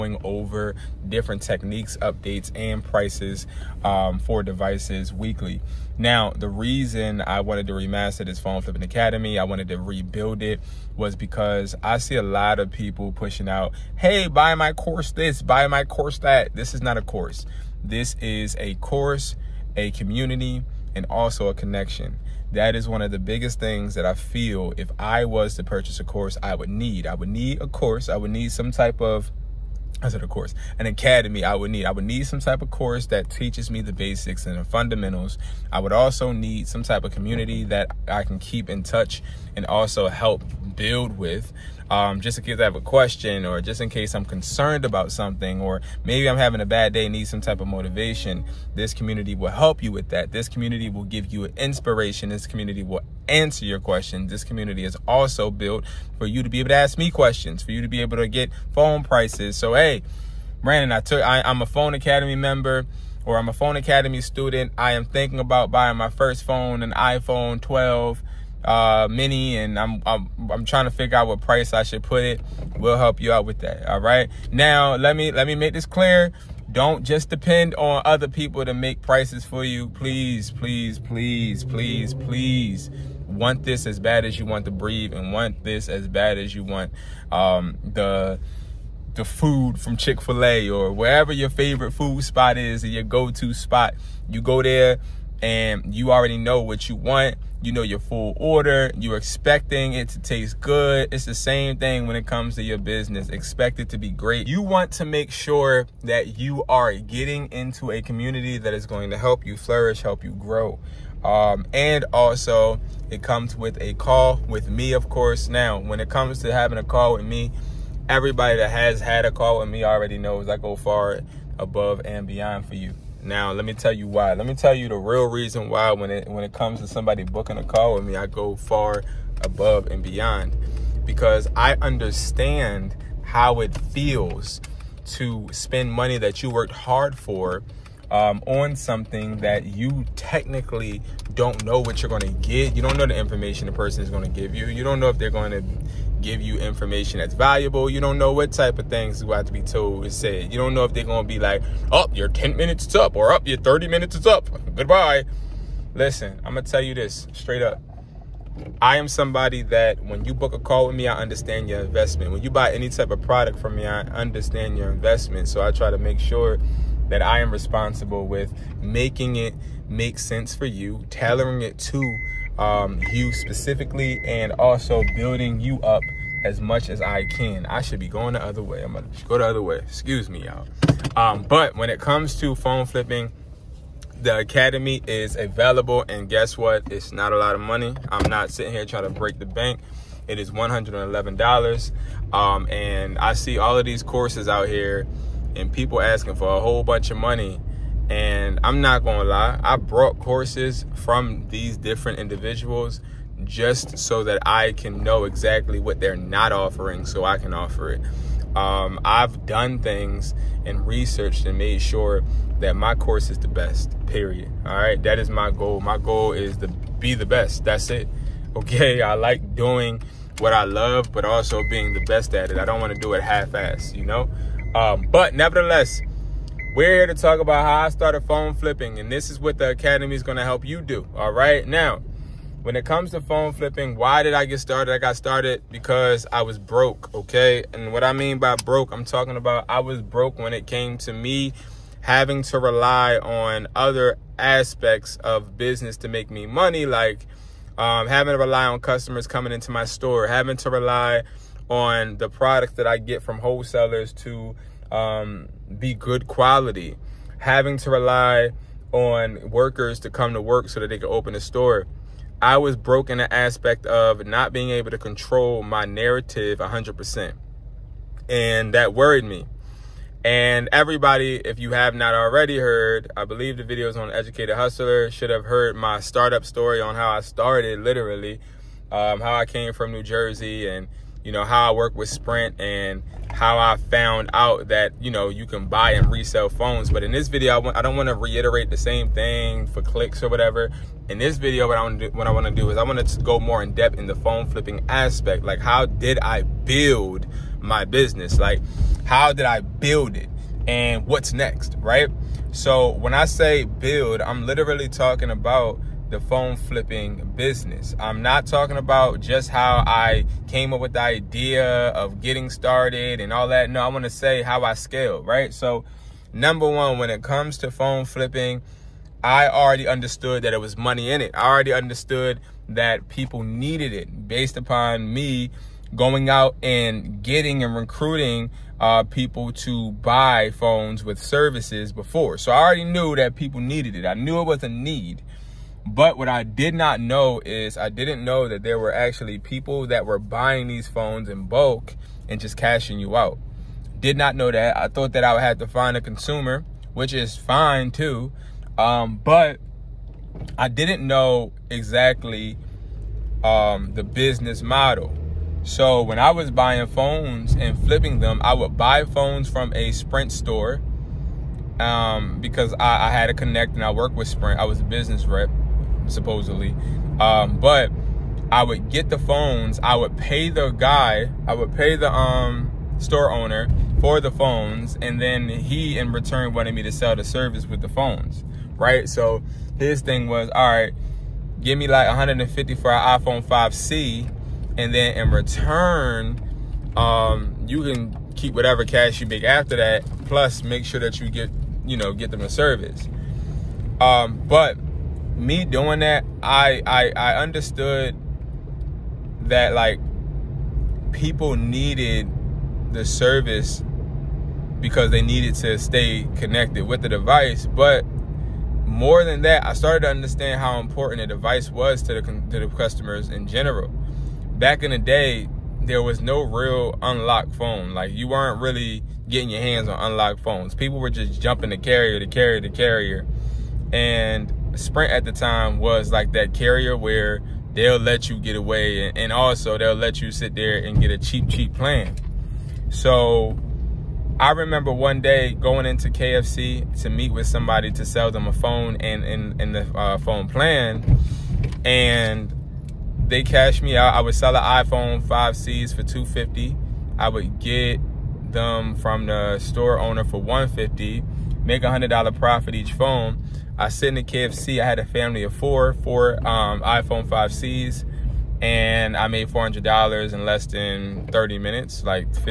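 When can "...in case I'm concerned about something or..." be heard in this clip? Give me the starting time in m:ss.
0:43.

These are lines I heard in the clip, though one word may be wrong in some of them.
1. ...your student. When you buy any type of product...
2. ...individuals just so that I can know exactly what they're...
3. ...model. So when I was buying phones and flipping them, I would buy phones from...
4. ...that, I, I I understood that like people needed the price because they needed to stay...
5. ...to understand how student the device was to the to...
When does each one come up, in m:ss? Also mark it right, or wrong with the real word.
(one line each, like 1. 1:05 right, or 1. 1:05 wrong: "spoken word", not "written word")
1. 2:41 wrong: "investment", not "student"
2. 3:22 right
3. 5:54 right
4. 6:35 wrong: "service", not "price"
5. 6:50 wrong: "important", not "student".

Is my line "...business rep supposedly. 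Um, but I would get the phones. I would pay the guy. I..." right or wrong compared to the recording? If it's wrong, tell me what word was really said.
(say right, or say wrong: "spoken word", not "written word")
right.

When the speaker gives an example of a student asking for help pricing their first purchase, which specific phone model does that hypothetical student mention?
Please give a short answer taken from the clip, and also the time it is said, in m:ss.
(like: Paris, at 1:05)
iPhone 12 mini, at 1:06.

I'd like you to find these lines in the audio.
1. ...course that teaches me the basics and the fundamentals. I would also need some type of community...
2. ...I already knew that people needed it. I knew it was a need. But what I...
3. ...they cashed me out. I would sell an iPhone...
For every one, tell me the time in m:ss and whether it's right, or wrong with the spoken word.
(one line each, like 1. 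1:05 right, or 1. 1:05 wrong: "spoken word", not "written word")
1. 0:32 right
2. 5:32 right
3. 7:23 right.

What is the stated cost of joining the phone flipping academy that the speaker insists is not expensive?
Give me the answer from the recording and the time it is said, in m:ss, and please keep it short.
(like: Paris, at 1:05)
$111, at 3:10.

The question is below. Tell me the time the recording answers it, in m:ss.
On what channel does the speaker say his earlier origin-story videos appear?
4:34.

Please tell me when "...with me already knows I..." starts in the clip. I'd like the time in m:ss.
1:59.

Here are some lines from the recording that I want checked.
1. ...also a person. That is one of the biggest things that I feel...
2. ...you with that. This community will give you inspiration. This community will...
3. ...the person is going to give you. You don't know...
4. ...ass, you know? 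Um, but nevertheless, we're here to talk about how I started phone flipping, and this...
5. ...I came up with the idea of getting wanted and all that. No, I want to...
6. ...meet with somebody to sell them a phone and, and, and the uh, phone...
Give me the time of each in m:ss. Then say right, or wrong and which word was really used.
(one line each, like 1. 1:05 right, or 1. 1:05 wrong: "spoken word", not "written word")
1. 0:21 wrong: "connection", not "person"
2. 0:49 right
3. 2:23 right
4. 3:43 right
5. 5:09 wrong: "started", not "wanted"
6. 7:17 right.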